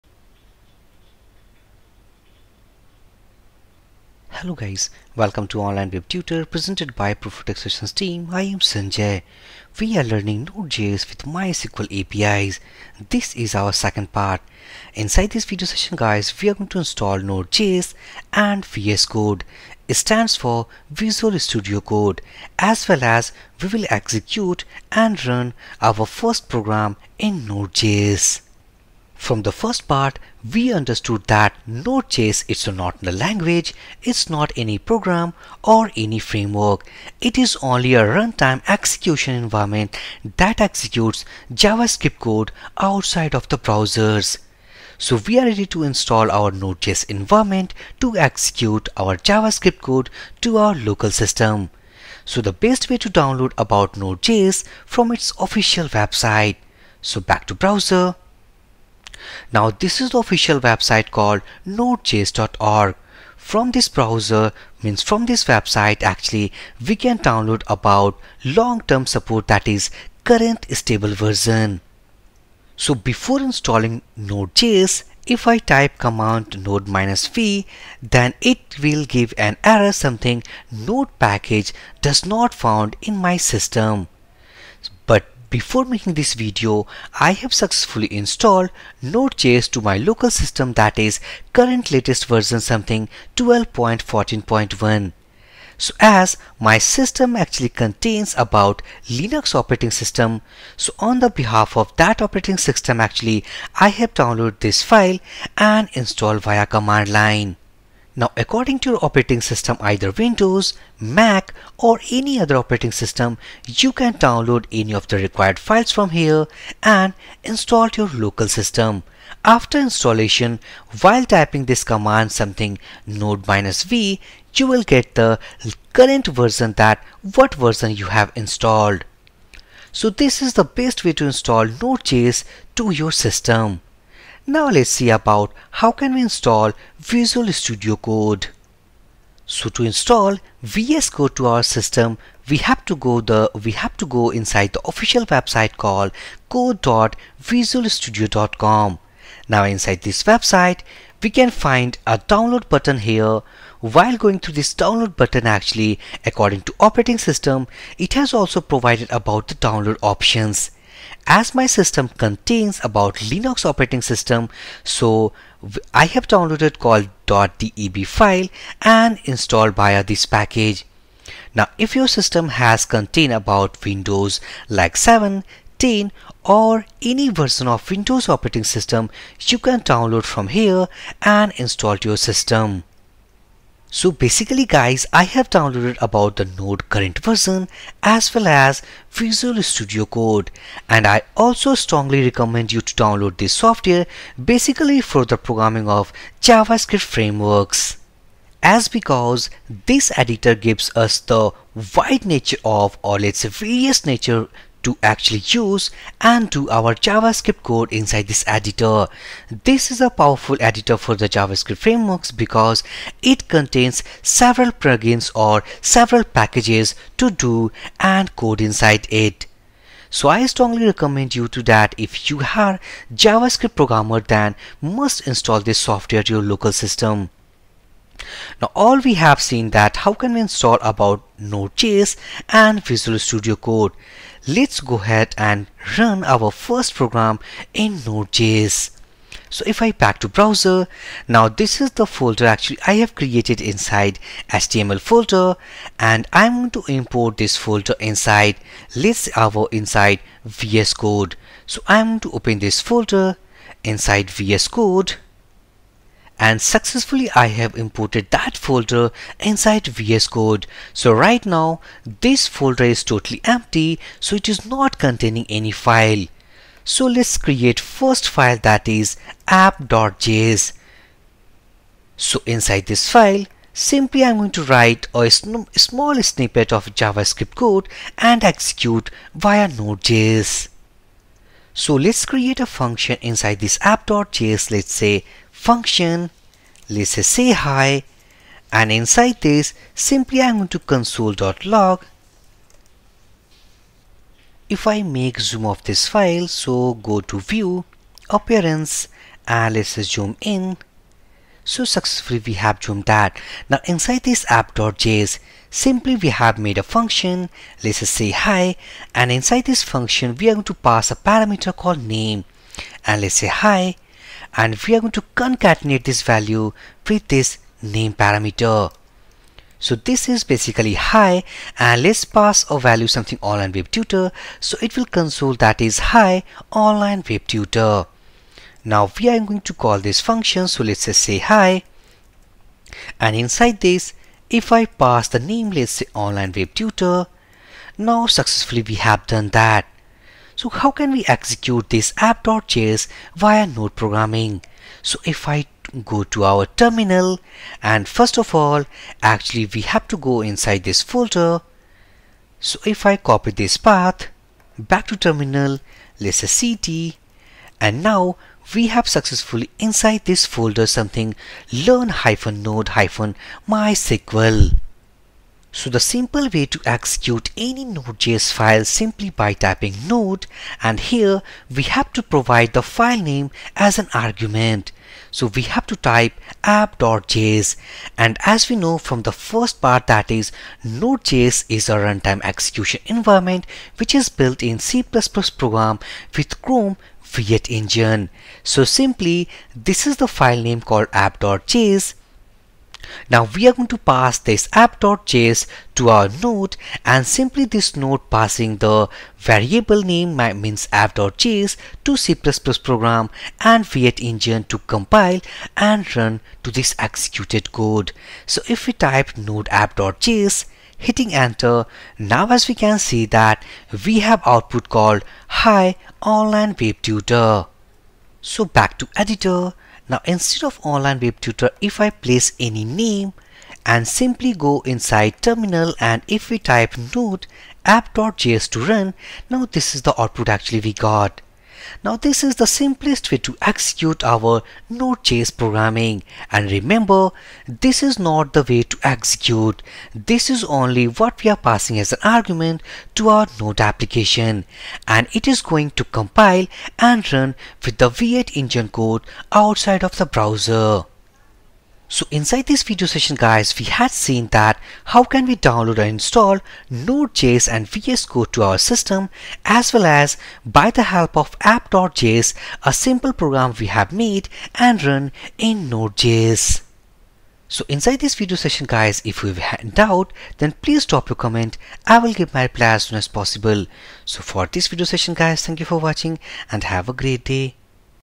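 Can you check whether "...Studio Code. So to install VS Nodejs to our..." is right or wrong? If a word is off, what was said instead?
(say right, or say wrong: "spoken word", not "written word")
wrong: "Code", not "Nodejs".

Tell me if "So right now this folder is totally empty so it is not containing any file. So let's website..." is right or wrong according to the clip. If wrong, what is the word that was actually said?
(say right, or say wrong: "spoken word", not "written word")
wrong: "create", not "website".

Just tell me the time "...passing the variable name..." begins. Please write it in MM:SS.
06:38.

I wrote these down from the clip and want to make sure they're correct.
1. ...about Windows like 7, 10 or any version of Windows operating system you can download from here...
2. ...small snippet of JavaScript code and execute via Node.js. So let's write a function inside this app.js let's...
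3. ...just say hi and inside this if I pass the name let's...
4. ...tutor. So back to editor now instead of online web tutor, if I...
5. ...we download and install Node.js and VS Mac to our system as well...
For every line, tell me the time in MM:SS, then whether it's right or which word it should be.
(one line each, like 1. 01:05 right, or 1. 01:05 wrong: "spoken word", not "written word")
1. 02:53 right
2. 04:35 wrong: "create", not "write"
3. 05:31 right
4. 06:57 right
5. 07:35 wrong: "Code", not "Mac".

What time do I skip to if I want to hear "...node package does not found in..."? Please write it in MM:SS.
01:20.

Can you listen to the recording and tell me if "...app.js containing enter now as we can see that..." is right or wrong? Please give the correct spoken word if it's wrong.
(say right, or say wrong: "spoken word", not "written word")
wrong: "hitting", not "containing".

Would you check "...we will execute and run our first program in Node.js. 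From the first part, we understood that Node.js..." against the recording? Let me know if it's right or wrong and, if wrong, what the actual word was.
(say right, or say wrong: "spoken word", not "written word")
right.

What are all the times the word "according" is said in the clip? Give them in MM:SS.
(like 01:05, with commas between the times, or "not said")
01:48, 02:36.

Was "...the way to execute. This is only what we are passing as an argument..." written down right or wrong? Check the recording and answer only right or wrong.
right.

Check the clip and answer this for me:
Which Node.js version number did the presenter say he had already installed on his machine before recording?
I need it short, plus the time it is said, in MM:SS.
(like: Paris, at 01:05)
12.14.1, at 01:33.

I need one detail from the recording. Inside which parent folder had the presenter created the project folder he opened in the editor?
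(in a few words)
HTML.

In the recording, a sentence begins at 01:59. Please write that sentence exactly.
After installation while typing this command something node-v you will get the current version that what version you have installed.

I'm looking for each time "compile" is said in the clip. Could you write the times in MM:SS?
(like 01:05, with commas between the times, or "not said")
06:44, 07:26.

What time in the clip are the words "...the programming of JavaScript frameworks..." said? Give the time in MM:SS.
03:15.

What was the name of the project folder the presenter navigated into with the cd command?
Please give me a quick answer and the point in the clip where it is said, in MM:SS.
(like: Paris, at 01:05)
learn-node-mysql, at 06:01.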